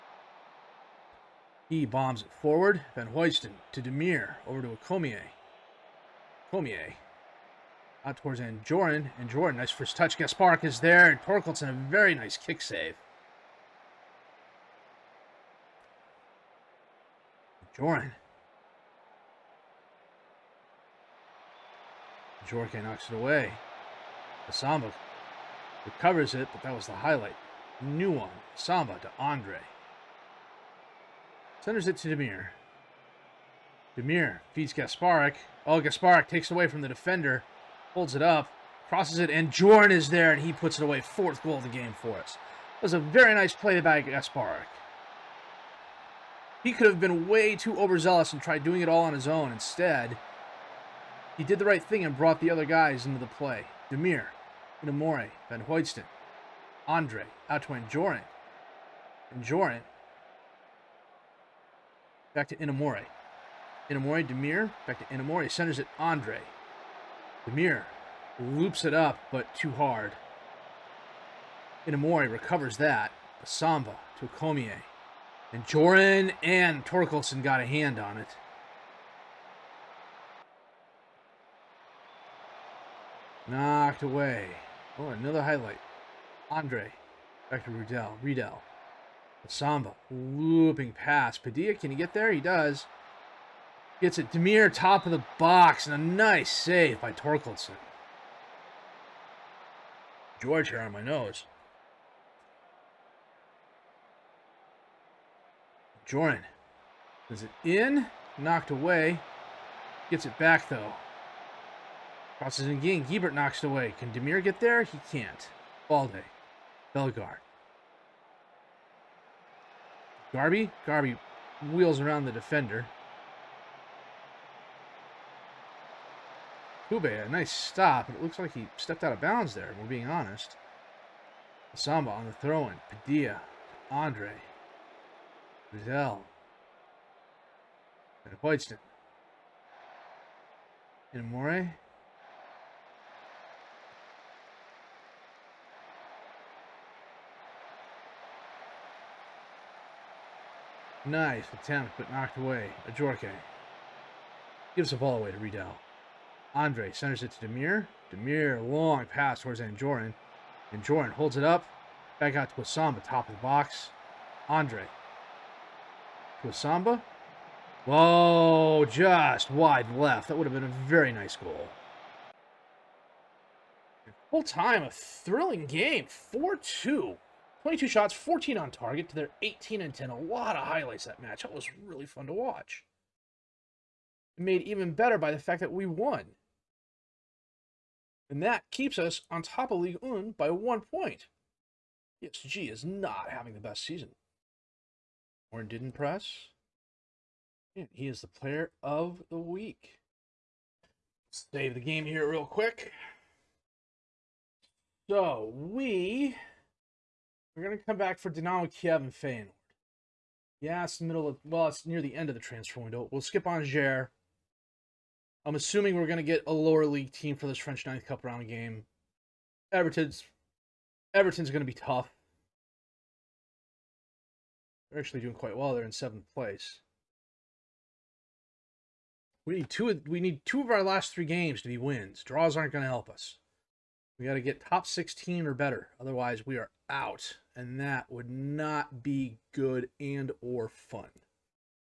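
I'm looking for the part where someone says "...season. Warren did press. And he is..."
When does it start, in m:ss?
3:13.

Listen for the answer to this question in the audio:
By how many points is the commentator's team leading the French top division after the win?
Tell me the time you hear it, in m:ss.
3:10.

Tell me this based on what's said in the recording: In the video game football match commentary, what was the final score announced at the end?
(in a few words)
4-2.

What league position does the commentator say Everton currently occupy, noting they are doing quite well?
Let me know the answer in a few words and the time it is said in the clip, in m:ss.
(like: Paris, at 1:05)
Seventh place, at 3:45.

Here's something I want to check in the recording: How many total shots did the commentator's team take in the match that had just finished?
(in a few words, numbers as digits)
22.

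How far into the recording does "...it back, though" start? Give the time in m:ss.
1:50.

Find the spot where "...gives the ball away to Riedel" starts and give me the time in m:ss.
2:34.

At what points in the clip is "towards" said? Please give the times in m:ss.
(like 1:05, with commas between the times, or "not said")
0:08, 2:39.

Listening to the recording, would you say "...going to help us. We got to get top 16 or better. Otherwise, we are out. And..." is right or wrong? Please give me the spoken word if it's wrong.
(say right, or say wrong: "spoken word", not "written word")
right.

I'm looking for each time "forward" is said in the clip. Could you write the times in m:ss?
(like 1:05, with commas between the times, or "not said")
0:02.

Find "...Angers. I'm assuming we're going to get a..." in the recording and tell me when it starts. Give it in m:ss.
3:33.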